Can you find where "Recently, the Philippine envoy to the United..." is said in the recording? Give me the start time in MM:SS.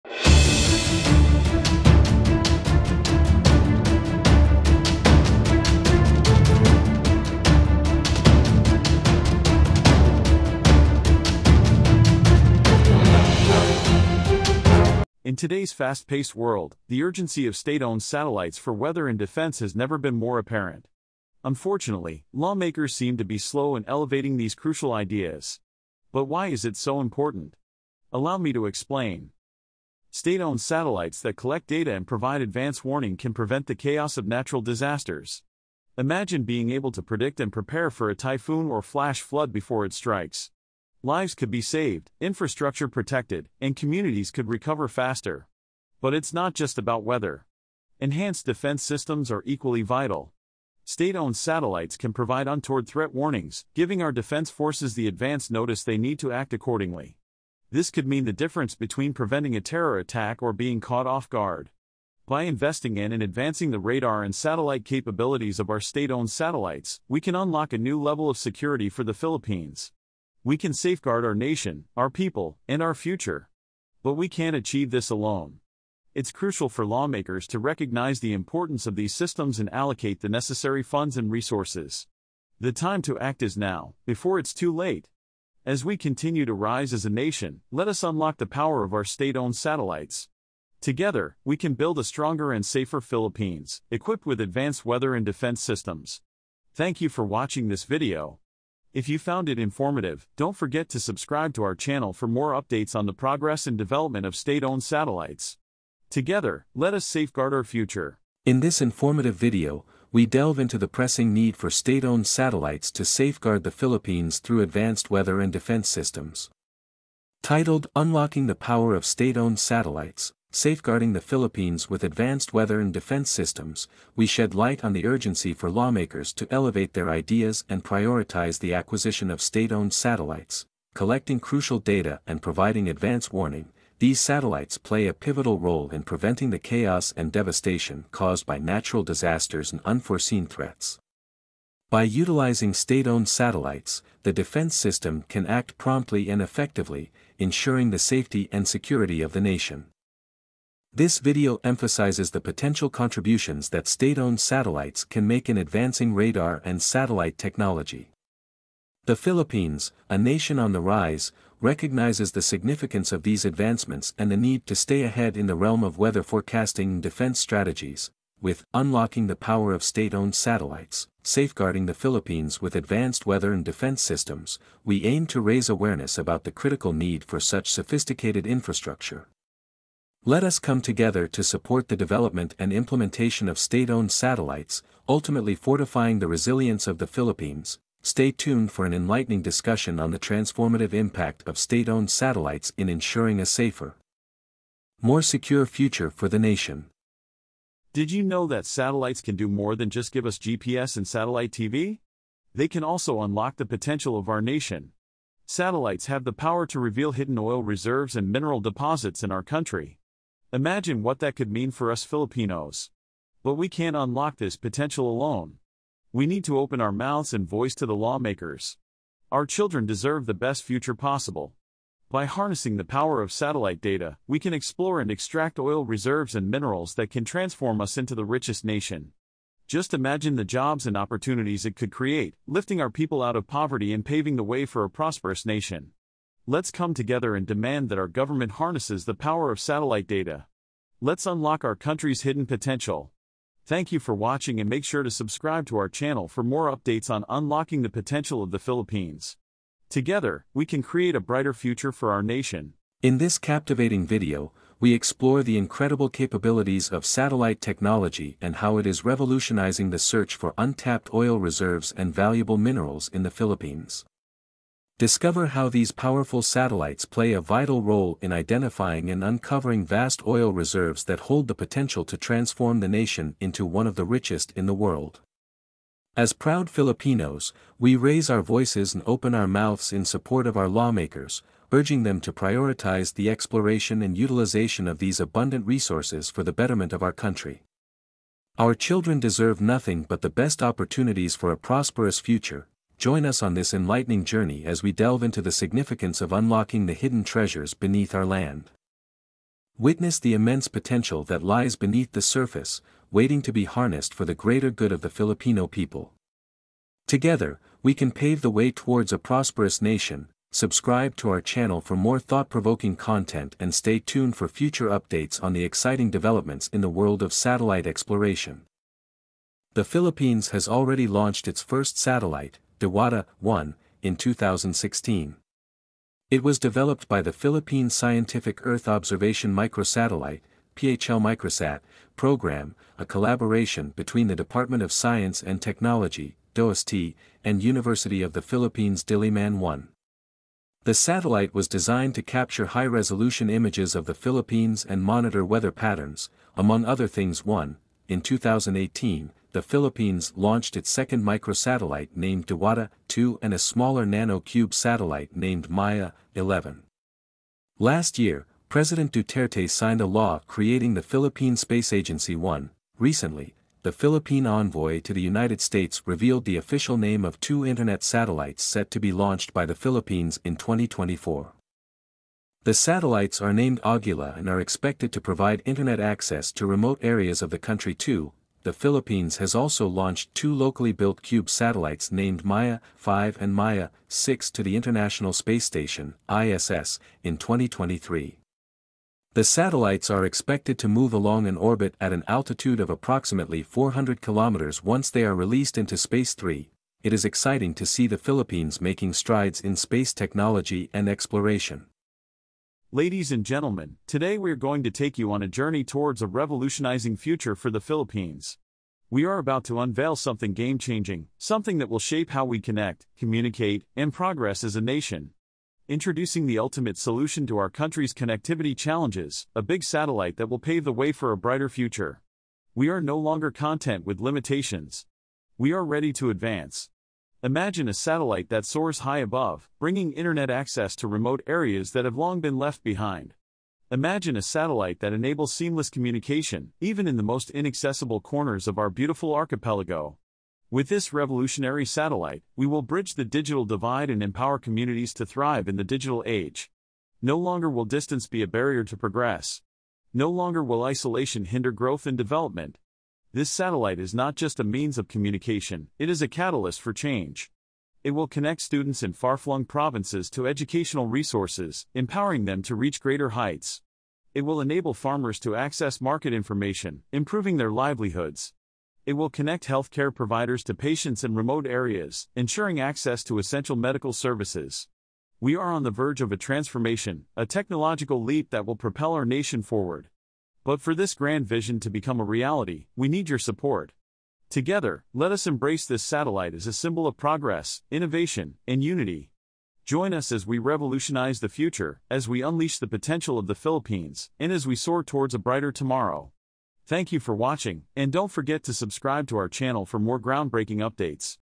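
06:02.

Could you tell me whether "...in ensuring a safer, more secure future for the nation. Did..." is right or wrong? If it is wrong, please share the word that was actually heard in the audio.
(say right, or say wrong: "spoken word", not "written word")
right.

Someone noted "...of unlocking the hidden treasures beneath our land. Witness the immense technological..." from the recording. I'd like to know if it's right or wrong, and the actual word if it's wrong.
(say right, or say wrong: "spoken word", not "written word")
wrong: "potential", not "technological".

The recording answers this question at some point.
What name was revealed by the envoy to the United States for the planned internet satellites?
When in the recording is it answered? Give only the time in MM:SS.
06:13.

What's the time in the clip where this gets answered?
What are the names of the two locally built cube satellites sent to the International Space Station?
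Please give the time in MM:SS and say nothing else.
06:22.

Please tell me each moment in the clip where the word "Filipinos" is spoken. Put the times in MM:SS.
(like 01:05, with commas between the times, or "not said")
03:32, 04:36, 05:05.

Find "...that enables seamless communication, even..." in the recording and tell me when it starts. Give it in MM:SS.
07:14.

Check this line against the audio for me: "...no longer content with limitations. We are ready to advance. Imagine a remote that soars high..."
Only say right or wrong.
wrong.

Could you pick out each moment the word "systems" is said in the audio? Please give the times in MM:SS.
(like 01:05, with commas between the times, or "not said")
00:48, 01:19, 01:35, 01:55, 02:03, 02:24, 02:54.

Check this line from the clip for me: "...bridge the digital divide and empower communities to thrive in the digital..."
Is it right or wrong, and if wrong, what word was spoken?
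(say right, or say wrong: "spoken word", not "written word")
right.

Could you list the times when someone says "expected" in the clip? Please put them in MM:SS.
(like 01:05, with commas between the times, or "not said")
06:14, 06:30.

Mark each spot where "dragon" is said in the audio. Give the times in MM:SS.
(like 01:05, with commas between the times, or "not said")
not said.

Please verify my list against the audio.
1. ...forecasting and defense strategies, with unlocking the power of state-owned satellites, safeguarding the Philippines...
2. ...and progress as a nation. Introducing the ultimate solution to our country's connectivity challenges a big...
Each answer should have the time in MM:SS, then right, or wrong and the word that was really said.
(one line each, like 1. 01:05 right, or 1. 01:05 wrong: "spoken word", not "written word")
1. 02:46 right
2. 06:53 right.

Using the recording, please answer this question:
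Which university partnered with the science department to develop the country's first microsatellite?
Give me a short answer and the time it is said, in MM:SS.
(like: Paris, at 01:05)
University of the Philippines Diliman, at 05:37.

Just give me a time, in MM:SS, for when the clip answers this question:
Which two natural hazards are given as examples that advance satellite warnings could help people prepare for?
00:38.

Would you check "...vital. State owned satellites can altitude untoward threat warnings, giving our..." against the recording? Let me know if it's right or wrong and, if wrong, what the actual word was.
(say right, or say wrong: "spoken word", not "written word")
wrong: "provide", not "altitude".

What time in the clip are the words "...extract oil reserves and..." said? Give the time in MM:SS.
03:45.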